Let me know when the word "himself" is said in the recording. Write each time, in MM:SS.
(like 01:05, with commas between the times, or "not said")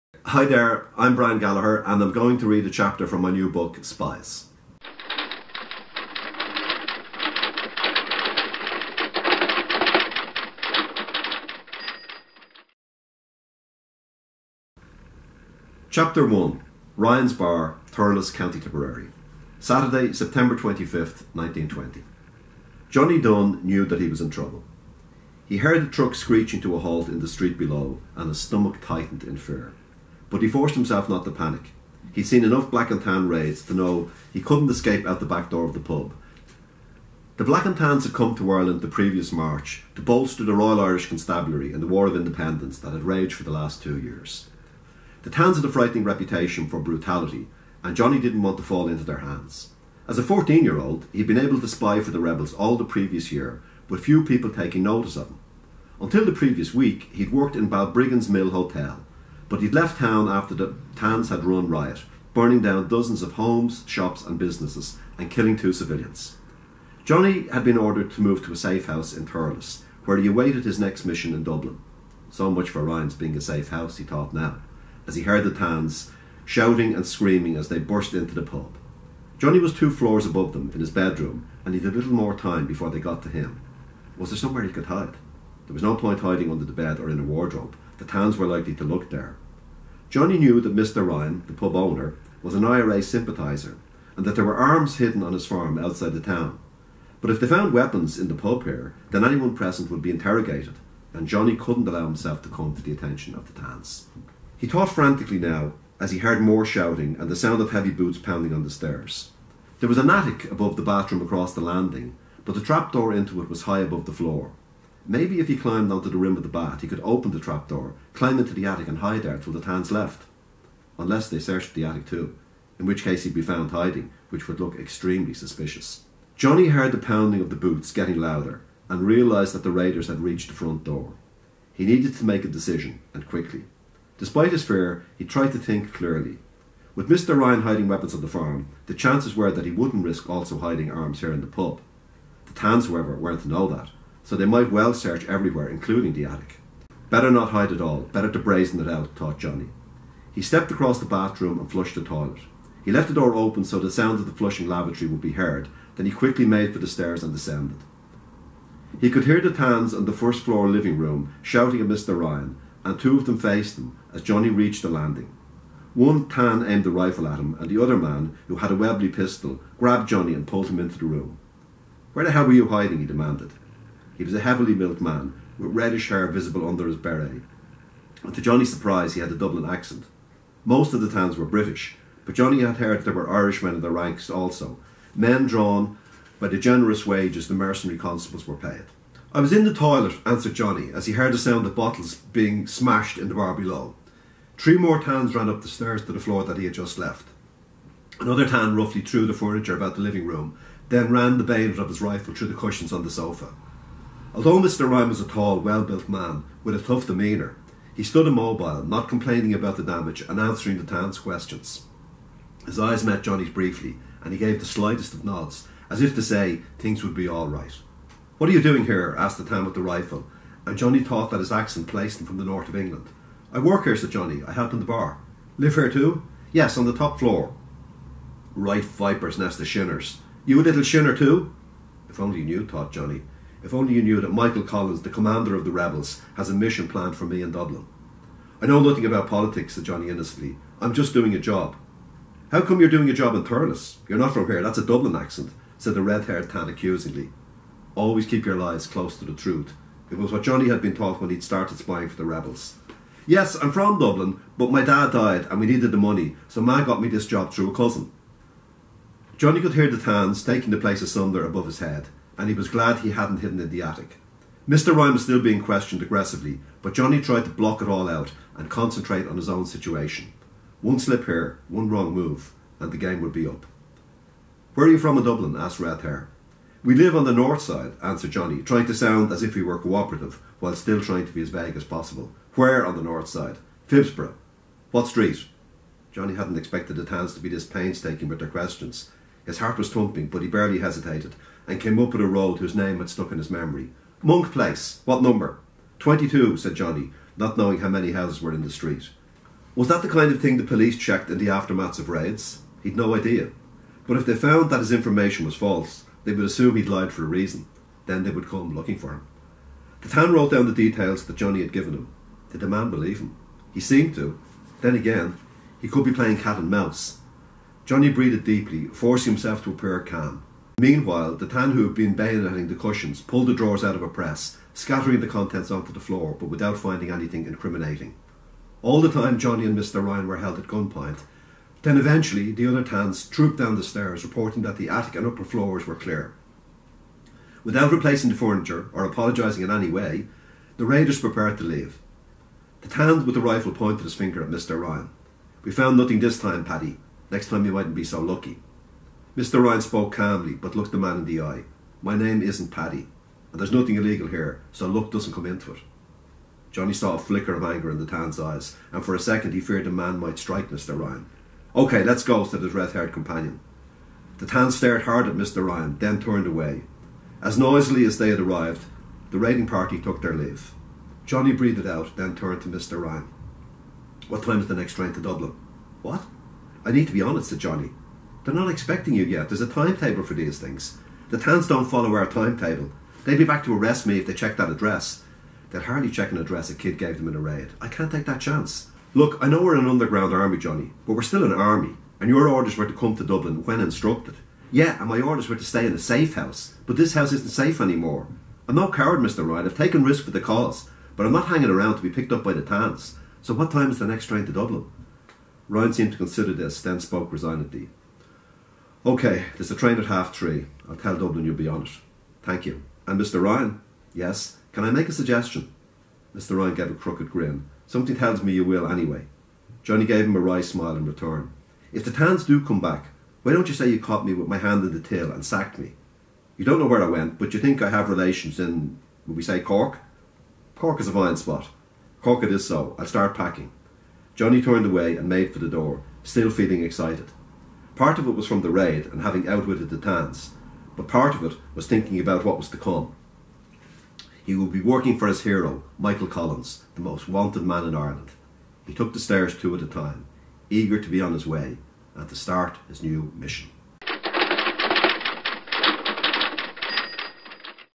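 00:30, 01:42, 05:19.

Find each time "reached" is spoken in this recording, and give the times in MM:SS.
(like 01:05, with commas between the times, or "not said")
02:10, 02:44.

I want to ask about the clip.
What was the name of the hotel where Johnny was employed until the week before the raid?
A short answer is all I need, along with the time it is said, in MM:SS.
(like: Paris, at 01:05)
Mill Hotel, at 00:58.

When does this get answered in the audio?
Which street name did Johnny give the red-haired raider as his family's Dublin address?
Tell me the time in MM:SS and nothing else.
04:54.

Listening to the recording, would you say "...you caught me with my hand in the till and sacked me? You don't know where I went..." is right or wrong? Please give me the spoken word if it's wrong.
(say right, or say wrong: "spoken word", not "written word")
right.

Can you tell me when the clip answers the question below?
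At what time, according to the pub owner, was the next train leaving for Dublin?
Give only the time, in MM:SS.
06:50.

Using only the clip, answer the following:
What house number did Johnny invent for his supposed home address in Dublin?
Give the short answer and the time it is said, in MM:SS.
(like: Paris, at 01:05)
22, at 04:55.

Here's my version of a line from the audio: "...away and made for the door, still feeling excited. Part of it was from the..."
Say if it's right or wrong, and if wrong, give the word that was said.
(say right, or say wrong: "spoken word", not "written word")
right.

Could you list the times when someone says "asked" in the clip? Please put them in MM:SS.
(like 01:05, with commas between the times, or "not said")
03:39, 04:35.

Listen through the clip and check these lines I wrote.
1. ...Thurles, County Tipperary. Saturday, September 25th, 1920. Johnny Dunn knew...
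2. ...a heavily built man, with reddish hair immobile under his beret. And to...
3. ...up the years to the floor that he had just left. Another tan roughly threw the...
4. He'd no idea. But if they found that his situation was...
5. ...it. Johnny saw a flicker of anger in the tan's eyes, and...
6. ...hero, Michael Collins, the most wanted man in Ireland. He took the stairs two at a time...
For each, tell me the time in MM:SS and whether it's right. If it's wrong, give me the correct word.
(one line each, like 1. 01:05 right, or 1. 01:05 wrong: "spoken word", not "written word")
1. 00:17 right
2. 02:54 wrong: "visible", not "immobile"
3. 03:15 wrong: "stairs", not "years"
4. 05:02 wrong: "information", not "situation"
5. 05:55 right
6. 07:25 right.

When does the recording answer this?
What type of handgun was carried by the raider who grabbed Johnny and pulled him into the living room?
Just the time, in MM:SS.
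02:48.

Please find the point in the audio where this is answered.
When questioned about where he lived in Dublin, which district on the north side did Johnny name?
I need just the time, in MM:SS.
04:43.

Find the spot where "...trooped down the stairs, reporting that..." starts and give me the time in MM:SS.
05:33.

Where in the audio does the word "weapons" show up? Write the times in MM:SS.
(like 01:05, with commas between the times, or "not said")
01:37, 02:17.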